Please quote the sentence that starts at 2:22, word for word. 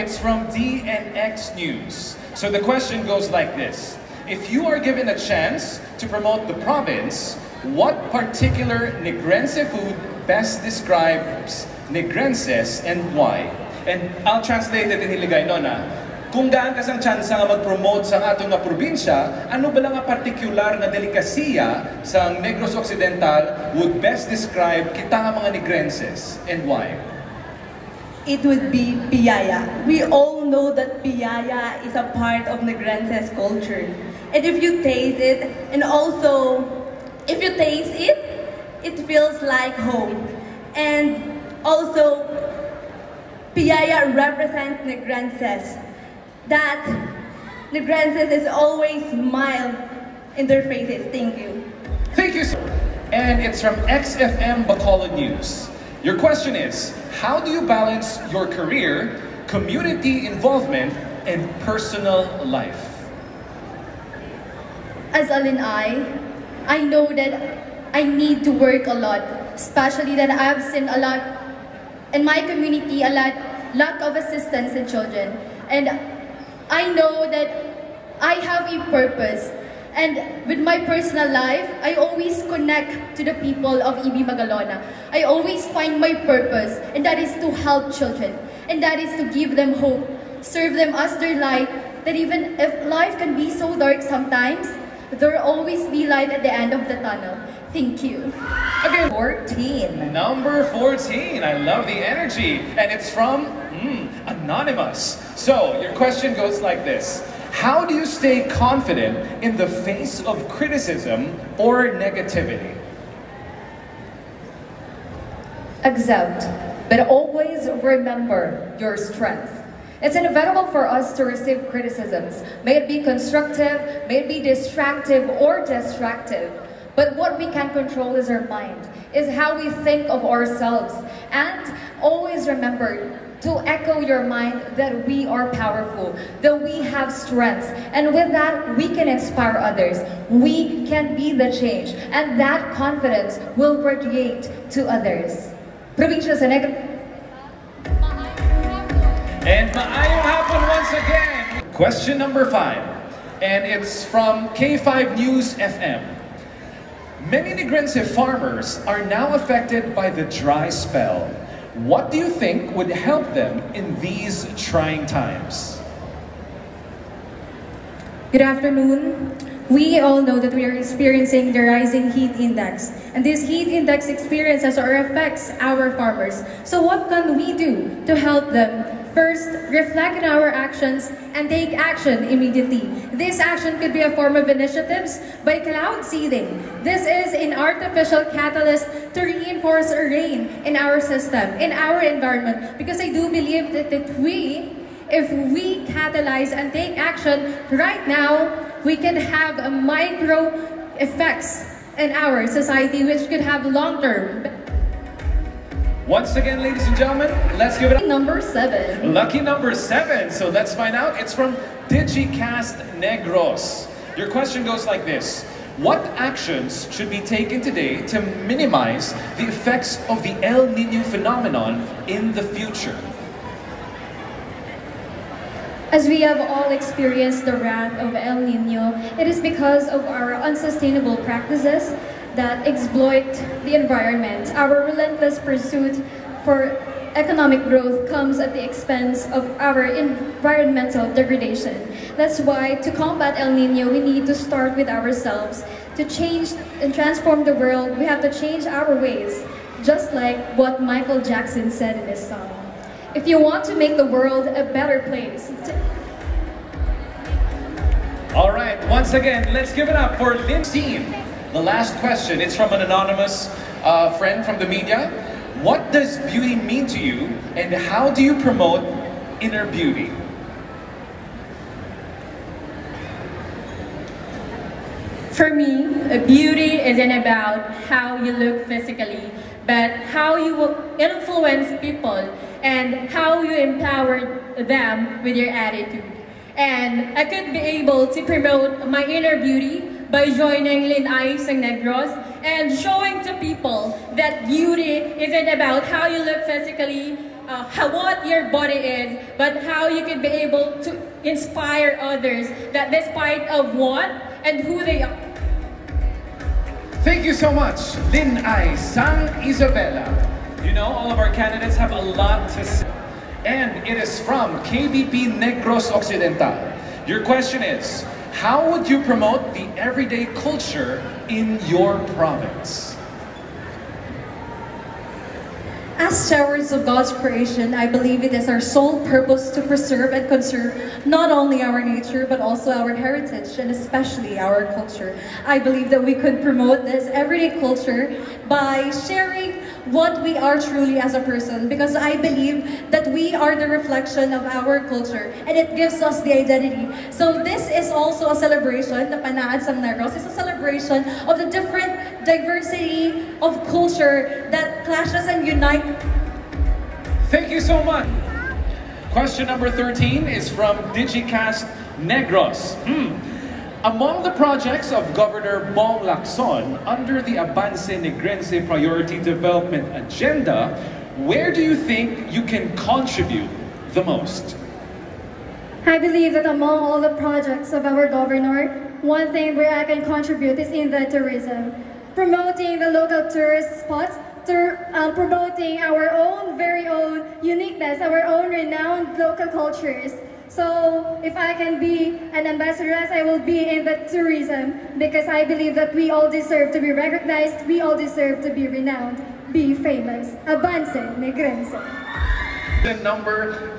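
And that confidence will radiate to others.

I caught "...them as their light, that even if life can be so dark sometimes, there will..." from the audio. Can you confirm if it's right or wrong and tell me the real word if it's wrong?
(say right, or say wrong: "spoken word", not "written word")
right.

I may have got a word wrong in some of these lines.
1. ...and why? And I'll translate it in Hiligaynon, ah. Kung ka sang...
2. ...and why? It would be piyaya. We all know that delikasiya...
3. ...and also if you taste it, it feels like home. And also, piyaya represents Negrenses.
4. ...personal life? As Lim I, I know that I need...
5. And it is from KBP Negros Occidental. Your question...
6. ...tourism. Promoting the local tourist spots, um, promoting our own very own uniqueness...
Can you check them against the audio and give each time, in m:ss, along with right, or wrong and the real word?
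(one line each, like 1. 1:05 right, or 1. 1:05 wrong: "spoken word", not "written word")
1. 0:12 right
2. 0:26 wrong: "piyaya", not "delikasiya"
3. 0:35 right
4. 1:01 wrong: "Alin", not "Lim"
5. 5:13 right
6. 6:21 right.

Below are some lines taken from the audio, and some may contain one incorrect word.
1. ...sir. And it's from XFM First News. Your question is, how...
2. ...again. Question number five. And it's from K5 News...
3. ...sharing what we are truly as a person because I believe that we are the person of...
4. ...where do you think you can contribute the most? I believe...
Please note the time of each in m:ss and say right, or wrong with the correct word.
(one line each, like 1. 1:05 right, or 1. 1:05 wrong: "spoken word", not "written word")
1. 0:52 wrong: "Bacolod", not "First"
2. 2:30 right
3. 5:39 wrong: "reflection", not "person"
4. 6:11 right.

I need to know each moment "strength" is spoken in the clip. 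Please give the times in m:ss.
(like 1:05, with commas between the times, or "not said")
1:58, 2:17.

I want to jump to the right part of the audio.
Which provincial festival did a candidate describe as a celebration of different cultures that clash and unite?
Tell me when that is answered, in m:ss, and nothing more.
5:49.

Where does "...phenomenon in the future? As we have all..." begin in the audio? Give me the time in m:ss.
3:41.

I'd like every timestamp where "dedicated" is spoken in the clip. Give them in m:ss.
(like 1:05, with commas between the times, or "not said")
not said.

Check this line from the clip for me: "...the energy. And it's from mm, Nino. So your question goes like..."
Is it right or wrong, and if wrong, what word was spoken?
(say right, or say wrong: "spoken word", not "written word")
wrong: "Anonymous", not "Nino".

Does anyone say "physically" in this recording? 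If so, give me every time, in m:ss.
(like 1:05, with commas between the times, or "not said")
4:38, 4:56.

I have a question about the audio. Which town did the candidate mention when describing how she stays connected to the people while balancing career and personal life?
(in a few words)
EB Magalona.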